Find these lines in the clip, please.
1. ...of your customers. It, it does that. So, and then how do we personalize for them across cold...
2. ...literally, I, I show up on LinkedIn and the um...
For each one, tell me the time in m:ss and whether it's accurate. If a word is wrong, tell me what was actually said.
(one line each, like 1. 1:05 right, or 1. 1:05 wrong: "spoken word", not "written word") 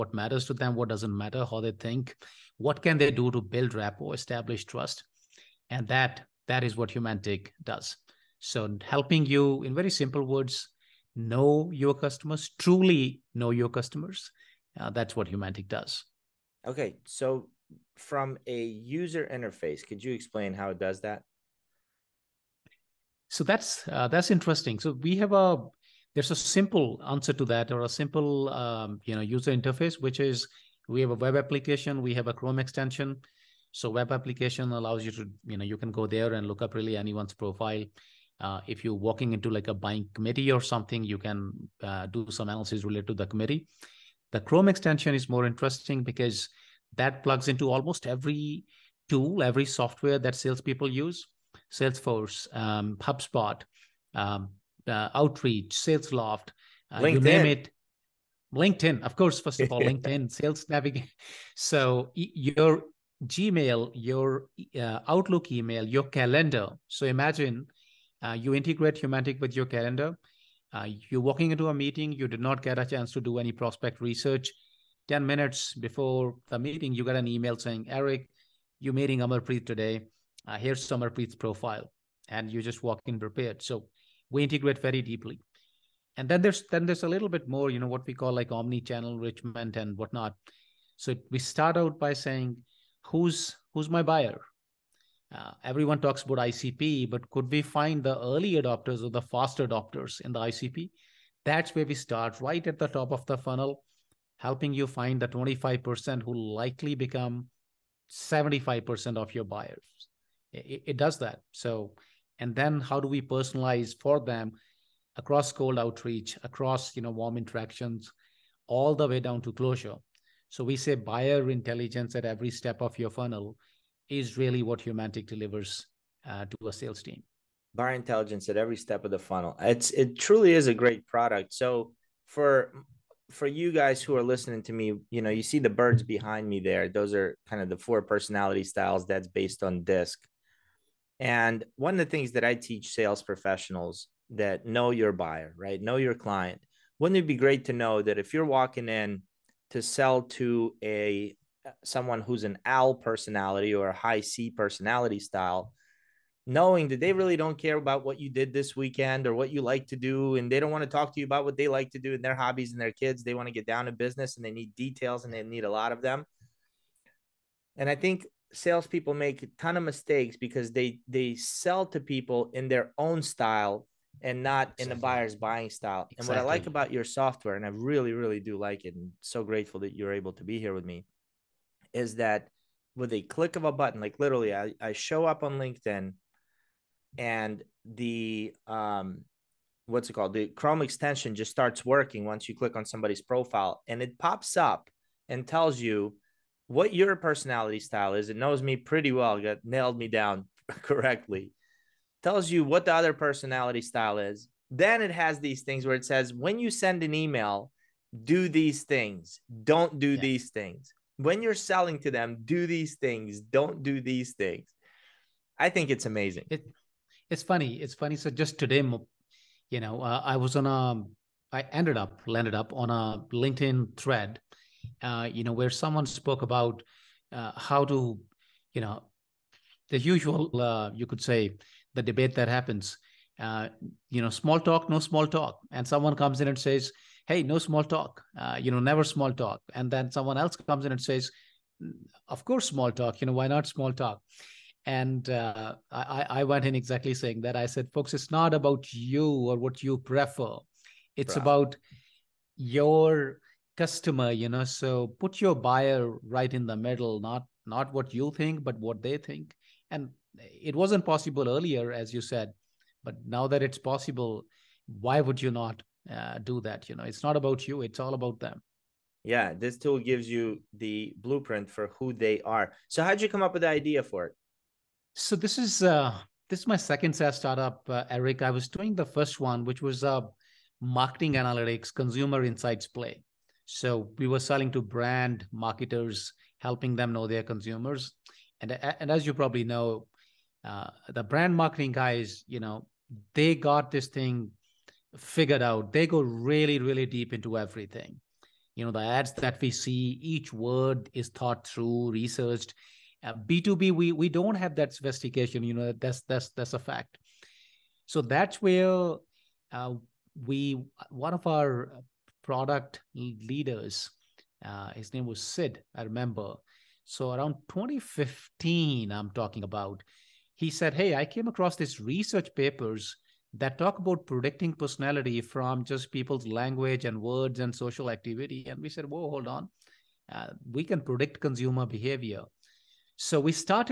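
1. 1:49 wrong: "buyers", not "customers"
2. 3:04 right.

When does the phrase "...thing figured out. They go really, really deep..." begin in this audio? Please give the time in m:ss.
4:54.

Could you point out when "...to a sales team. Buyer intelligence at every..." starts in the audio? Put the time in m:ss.
2:06.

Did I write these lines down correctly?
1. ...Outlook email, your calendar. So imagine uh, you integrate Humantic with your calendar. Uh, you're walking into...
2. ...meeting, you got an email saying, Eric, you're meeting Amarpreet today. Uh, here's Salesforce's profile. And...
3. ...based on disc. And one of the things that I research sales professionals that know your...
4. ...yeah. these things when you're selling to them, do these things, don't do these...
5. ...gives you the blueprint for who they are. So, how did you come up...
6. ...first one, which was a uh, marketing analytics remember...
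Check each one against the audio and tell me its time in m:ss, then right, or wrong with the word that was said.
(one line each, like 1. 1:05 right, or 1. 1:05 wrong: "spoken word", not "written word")
1. 1:05 right
2. 1:16 wrong: "Amarpreet", not "Salesforce"
3. 2:19 wrong: "teach", not "research"
4. 3:30 right
5. 4:29 right
6. 4:39 wrong: "consumer", not "remember".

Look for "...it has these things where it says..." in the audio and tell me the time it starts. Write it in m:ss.
3:25.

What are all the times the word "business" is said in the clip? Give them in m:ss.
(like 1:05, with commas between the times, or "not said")
2:43.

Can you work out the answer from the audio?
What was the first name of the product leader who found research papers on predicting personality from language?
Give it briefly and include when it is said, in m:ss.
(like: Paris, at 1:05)
Sid, at 5:15.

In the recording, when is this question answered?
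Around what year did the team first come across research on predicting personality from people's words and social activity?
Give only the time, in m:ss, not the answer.
5:17.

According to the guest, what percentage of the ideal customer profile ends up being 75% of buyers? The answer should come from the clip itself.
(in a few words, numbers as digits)
25%.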